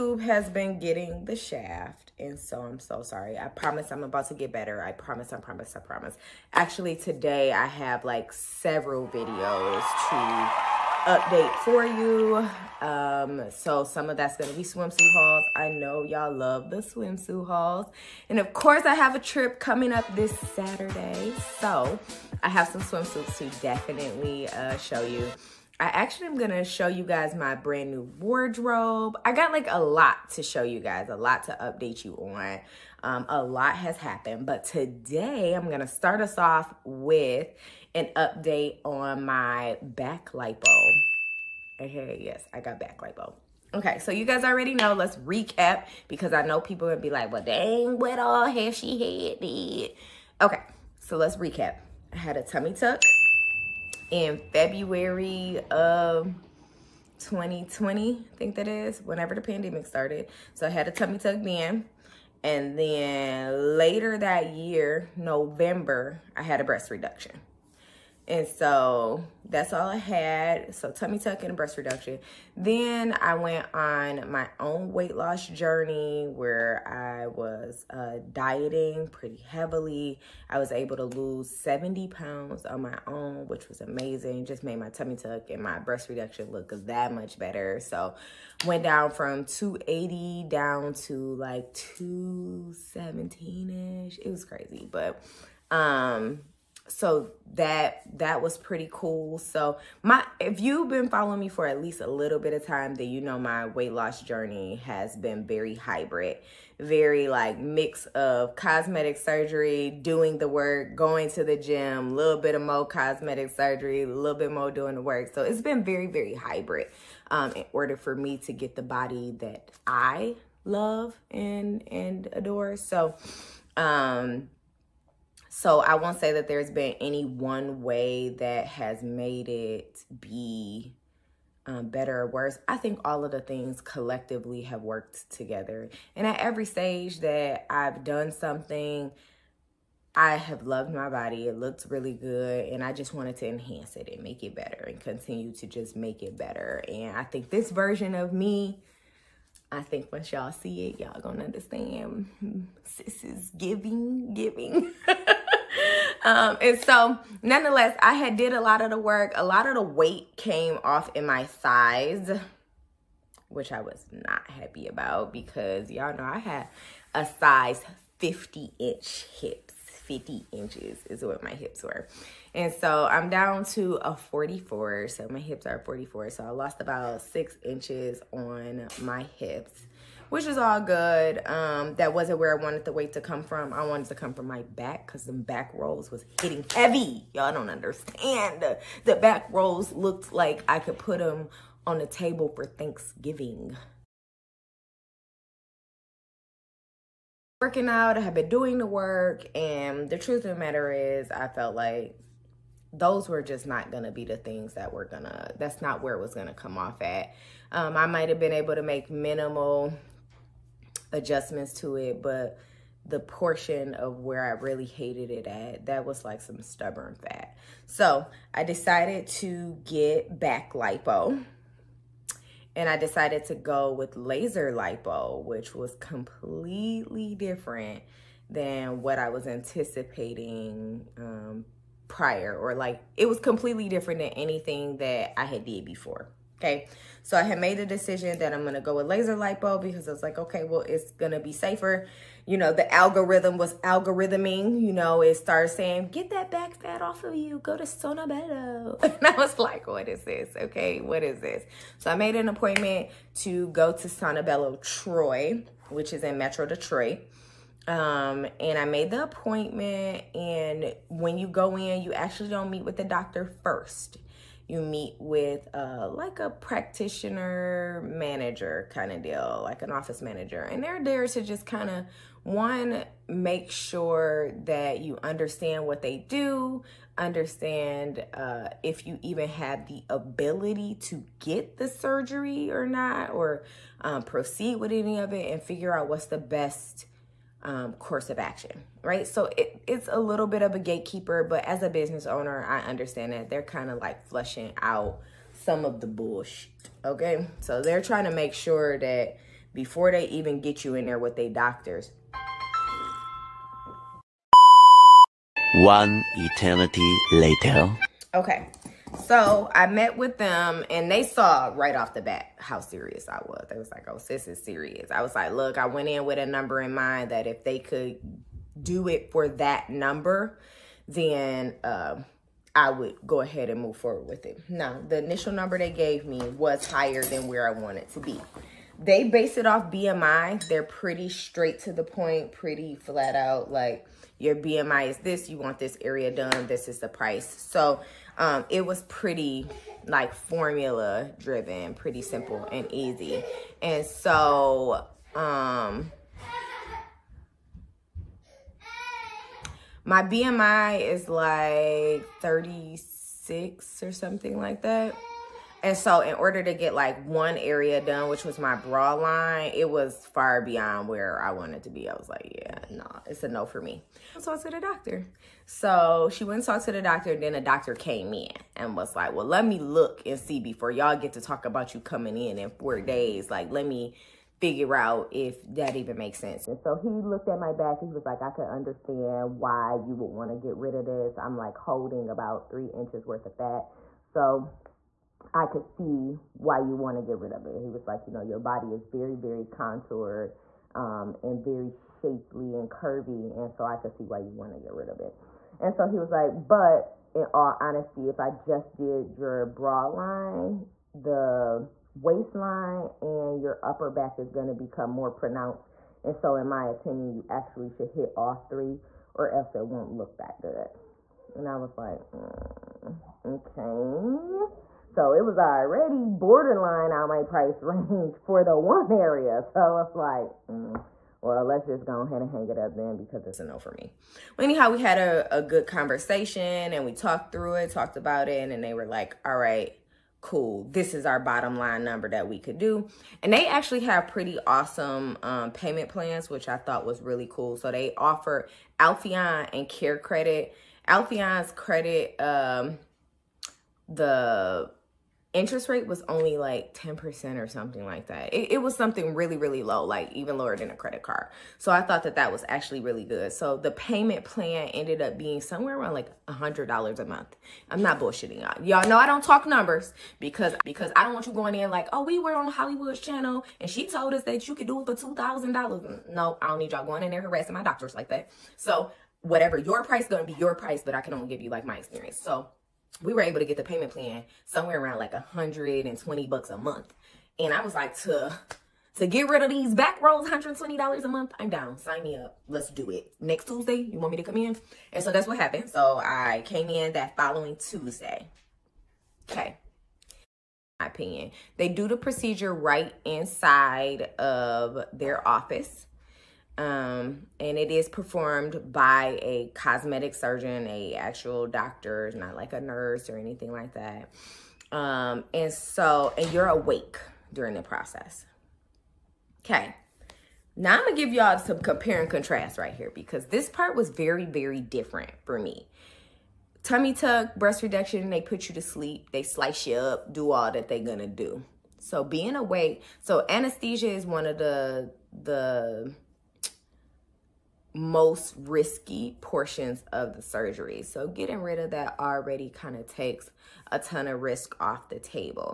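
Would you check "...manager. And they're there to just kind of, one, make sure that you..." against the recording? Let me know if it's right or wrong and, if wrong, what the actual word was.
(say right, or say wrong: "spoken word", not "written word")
right.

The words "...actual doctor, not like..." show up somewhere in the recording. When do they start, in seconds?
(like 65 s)
501 s.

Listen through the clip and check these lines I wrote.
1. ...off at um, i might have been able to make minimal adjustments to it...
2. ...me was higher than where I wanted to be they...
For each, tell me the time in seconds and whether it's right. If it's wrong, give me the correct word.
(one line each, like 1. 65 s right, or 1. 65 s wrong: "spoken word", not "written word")
1. 206 s right
2. 326 s right.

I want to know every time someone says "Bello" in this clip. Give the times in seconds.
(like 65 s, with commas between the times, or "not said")
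248 s, 254 s.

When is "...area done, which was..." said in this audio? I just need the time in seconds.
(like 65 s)
357 s.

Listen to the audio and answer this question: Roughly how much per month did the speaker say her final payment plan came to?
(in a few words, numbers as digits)
$120.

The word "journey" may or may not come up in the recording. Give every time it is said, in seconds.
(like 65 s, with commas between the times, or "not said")
75 s, 104 s.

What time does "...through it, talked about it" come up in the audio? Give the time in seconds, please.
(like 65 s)
427 s.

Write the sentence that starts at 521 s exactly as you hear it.
So being awake, so anesthesia is one of the the most risky portions of the surgery.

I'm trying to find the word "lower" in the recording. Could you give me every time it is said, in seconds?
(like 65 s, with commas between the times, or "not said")
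450 s.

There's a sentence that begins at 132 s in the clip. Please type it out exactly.
I think all of the things collectively have worked together.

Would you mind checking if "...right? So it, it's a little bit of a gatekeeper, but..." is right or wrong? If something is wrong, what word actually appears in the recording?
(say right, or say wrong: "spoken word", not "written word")
right.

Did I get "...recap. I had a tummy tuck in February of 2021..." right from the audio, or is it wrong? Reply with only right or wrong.
wrong.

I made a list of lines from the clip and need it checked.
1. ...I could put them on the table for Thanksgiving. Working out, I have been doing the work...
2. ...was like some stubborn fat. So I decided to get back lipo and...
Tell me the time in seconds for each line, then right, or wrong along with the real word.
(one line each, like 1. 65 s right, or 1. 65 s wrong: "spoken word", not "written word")
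1. 190 s right
2. 216 s right.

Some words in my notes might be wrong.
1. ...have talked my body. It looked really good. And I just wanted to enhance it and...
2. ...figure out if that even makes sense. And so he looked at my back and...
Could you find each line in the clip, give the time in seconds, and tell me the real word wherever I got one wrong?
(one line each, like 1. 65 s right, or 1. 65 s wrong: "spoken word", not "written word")
1. 140 s wrong: "loved", not "talked"
2. 374 s right.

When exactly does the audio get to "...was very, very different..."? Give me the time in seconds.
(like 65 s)
513 s.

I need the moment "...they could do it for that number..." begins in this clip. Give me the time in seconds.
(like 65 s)
317 s.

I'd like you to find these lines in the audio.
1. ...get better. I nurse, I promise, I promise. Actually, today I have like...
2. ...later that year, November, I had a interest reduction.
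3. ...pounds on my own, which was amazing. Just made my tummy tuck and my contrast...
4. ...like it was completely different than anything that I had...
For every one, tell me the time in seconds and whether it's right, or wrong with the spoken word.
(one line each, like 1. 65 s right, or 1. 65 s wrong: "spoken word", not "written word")
1. 4 s wrong: "promise", not "nurse"
2. 63 s wrong: "breast", not "interest"
3. 82 s wrong: "breast", not "contrast"
4. 232 s right.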